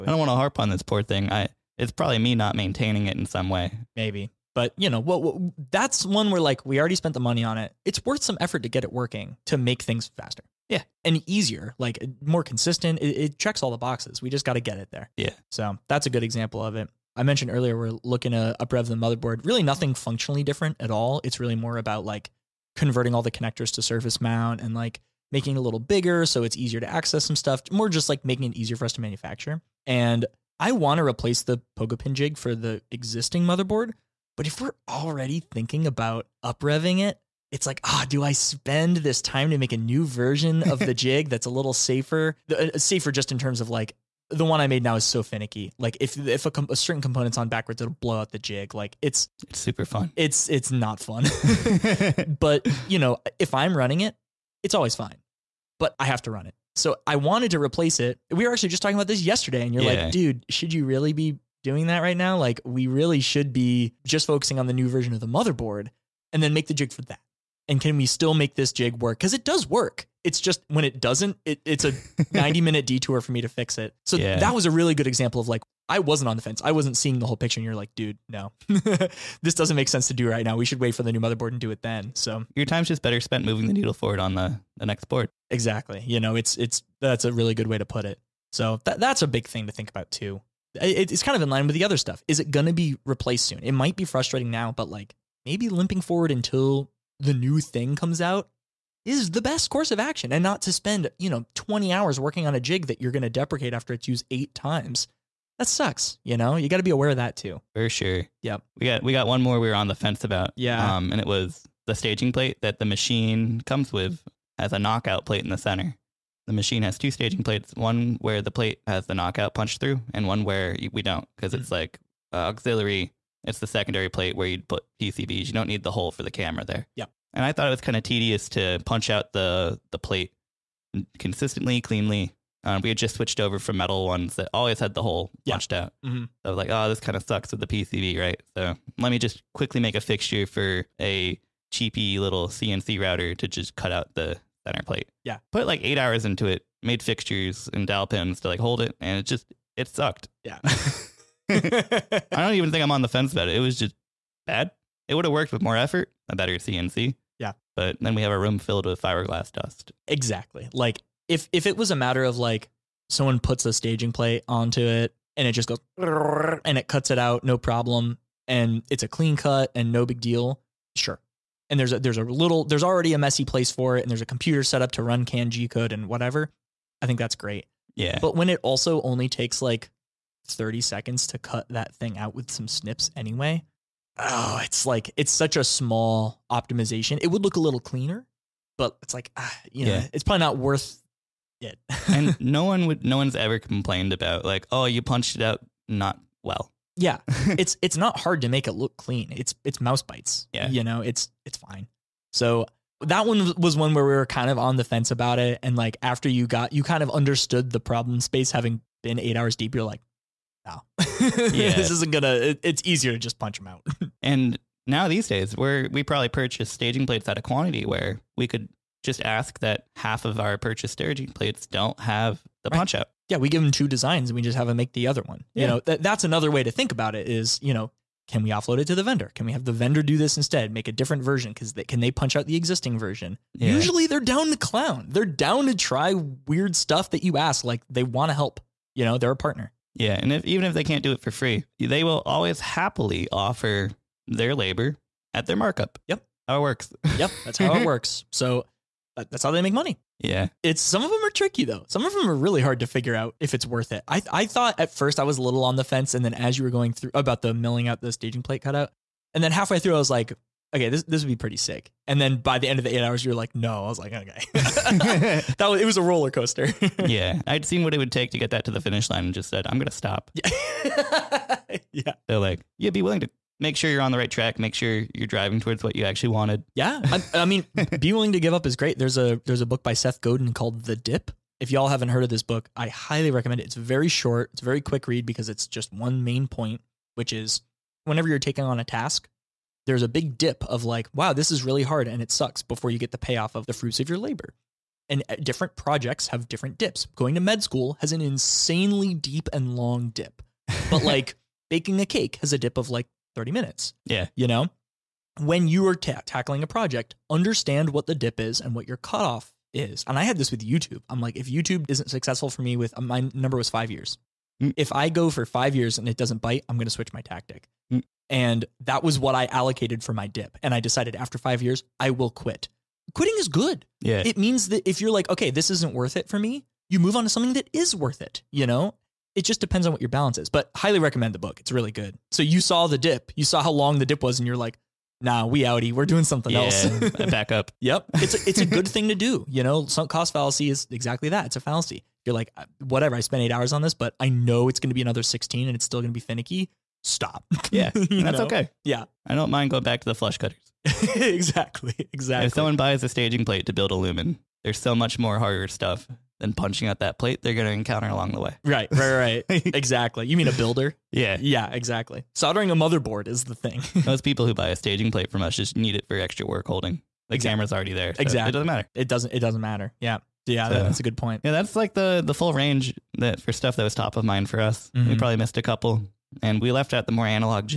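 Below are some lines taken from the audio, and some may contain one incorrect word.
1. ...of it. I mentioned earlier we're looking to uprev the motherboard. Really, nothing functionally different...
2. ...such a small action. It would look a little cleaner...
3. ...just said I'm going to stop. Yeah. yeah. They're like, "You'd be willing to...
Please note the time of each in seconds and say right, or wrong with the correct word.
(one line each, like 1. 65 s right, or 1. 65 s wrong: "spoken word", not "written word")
1. 16 s right
2. 185 s wrong: "optimization", not "action"
3. 269 s right.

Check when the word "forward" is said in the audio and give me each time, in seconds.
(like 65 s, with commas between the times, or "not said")
83 s, 96 s.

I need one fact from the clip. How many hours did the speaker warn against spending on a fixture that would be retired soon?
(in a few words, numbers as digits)
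20 hours.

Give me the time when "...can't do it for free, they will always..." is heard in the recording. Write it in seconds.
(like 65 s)
240 s.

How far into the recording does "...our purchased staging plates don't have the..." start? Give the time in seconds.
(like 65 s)
220 s.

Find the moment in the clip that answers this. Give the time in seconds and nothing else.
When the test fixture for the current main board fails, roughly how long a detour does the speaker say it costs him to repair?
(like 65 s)
72 s.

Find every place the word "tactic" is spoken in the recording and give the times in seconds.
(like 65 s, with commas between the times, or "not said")
317 s.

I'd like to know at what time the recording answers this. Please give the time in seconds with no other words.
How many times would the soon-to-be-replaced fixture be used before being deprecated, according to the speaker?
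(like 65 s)
104 s.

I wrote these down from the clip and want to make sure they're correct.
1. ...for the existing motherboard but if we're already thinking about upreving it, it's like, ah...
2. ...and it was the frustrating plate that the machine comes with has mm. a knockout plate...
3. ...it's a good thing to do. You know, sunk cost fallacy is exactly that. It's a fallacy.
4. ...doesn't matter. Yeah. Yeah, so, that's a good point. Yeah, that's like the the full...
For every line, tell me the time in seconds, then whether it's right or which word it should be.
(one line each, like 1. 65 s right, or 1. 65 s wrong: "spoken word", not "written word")
1. 32 s right
2. 111 s wrong: "staging", not "frustrating"
3. 338 s right
4. 369 s right.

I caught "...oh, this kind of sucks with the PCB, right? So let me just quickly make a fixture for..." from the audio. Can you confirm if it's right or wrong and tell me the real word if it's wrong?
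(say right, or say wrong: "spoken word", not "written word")
right.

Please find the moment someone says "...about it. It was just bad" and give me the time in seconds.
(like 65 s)
153 s.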